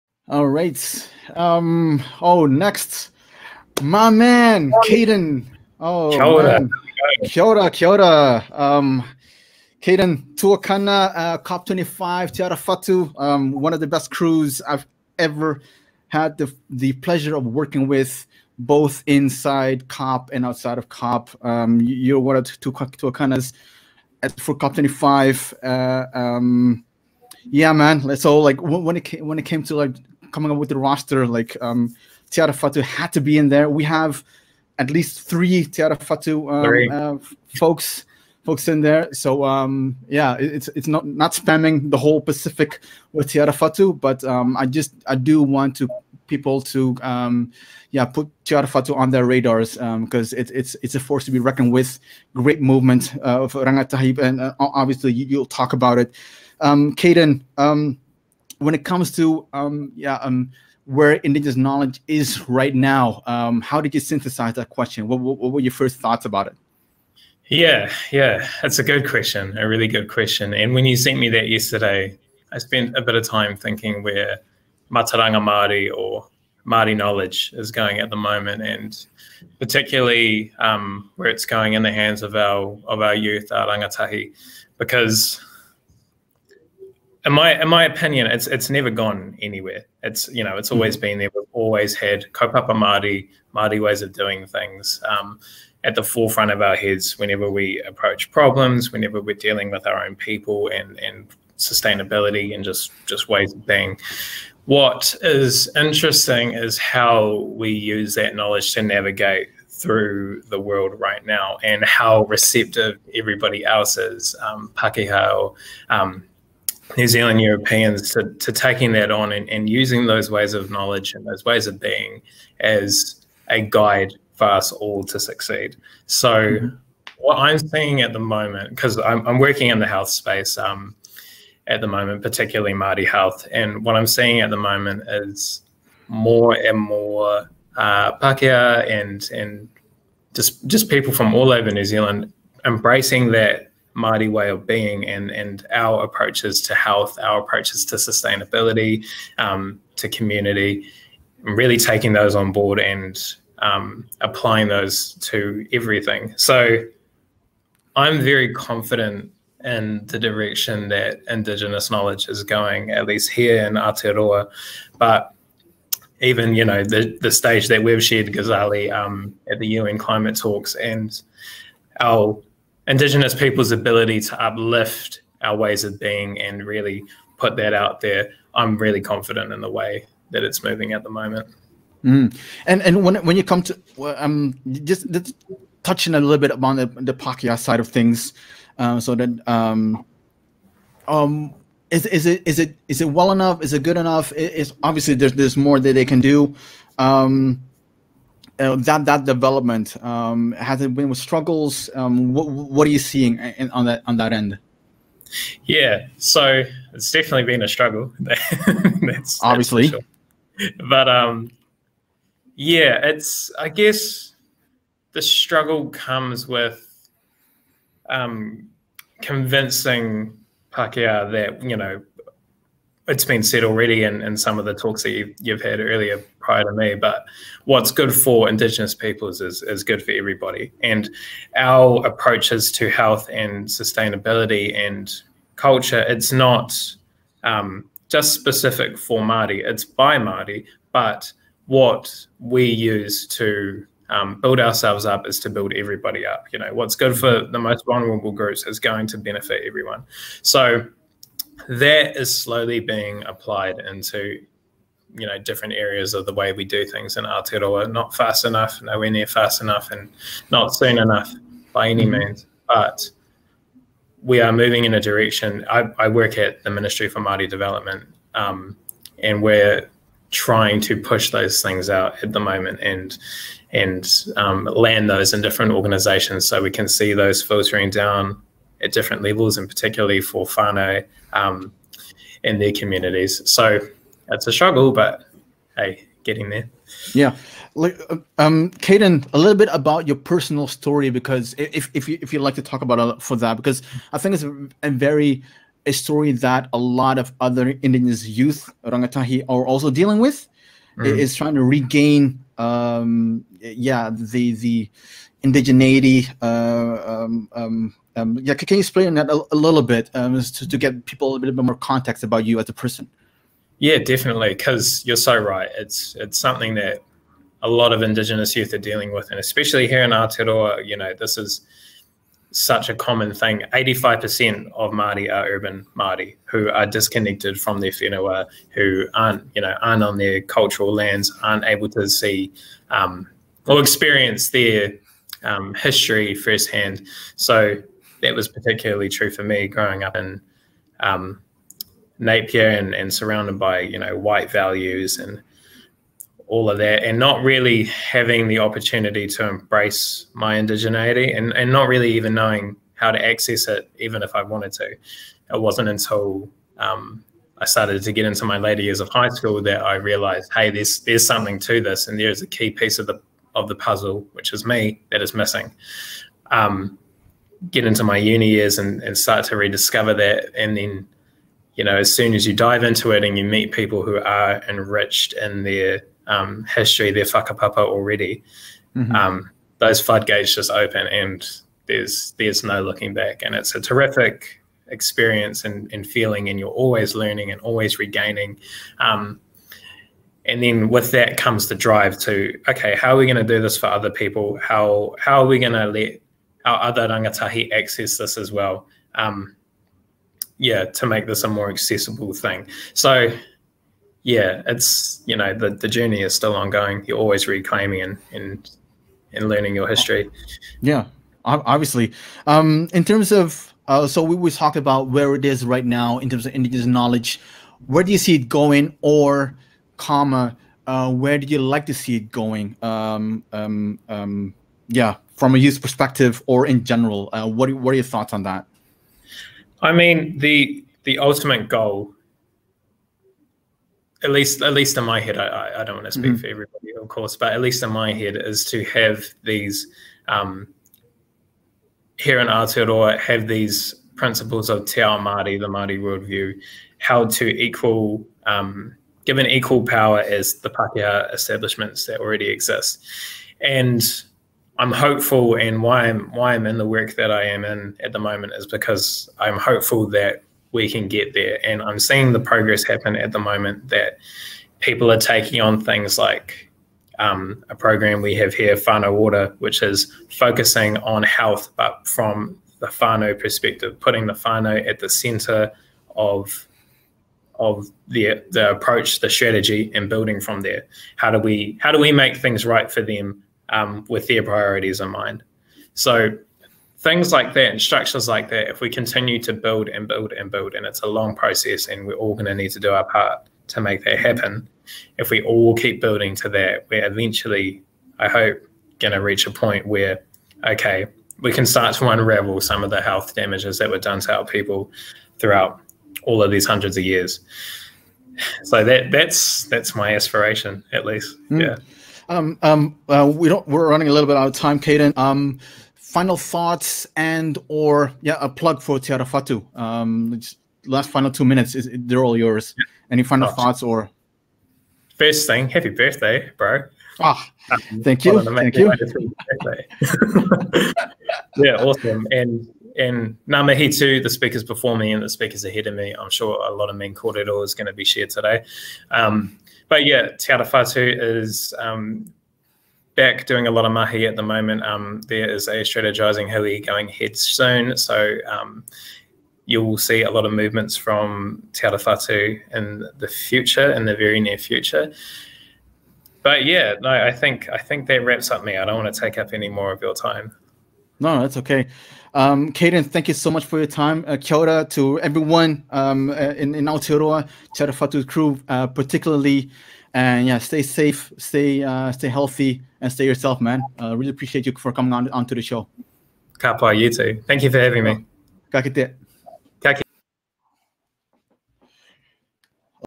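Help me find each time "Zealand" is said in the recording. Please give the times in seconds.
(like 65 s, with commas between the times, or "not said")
117 s, 141 s.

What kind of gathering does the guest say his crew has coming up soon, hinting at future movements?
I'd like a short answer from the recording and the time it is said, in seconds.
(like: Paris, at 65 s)
strategizing hui, at 545 s.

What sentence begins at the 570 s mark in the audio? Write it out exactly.
And yeah, stay safe, stay uh, stay healthy, and stay yourself, man.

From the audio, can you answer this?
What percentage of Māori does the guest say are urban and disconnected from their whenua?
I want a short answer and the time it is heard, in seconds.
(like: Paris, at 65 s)
85%, at 323 s.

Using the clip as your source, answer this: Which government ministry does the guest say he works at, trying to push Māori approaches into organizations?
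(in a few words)
Ministry for Māori Development.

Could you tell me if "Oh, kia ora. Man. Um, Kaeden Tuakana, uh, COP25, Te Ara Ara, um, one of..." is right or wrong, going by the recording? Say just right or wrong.
wrong.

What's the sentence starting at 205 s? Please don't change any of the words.
Yeah, so it's definitely been a struggle.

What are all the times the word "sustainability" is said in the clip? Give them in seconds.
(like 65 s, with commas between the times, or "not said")
101 s, 147 s, 233 s.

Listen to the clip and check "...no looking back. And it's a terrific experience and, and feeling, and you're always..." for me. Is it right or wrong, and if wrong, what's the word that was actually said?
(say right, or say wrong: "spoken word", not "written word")
right.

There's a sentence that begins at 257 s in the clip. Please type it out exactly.
Not fast enough, nowhere near fast enough, and not soon enough by any mm-hmm.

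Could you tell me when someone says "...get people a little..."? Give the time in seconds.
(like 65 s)
310 s.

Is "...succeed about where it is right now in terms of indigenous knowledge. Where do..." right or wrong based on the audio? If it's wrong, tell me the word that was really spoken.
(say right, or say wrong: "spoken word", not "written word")
wrong: "talked", not "succeed".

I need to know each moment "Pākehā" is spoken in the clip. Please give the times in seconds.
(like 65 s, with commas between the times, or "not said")
114 s, 138 s, 187 s, 220 s, 450 s.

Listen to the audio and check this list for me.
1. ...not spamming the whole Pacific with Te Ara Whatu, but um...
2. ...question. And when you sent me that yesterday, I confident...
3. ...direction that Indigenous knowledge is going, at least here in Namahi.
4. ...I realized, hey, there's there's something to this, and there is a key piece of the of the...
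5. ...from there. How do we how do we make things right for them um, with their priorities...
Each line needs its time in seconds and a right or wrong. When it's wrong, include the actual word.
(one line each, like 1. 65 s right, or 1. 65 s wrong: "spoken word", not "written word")
1. 41 s right
2. 70 s wrong: "spent", not "confident"
3. 160 s wrong: "Aotearoa", not "Namahi"
4. 359 s right
5. 480 s right.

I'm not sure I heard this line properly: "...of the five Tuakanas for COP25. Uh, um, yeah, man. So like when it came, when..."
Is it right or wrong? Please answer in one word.
wrong.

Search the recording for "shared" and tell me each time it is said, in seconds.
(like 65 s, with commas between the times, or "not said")
168 s, 538 s.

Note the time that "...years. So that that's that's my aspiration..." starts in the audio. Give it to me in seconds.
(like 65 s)
507 s.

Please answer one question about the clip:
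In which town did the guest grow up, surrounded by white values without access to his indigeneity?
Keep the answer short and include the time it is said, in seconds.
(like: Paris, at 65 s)
Napier, at 342 s.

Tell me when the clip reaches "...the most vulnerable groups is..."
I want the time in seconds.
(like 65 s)
247 s.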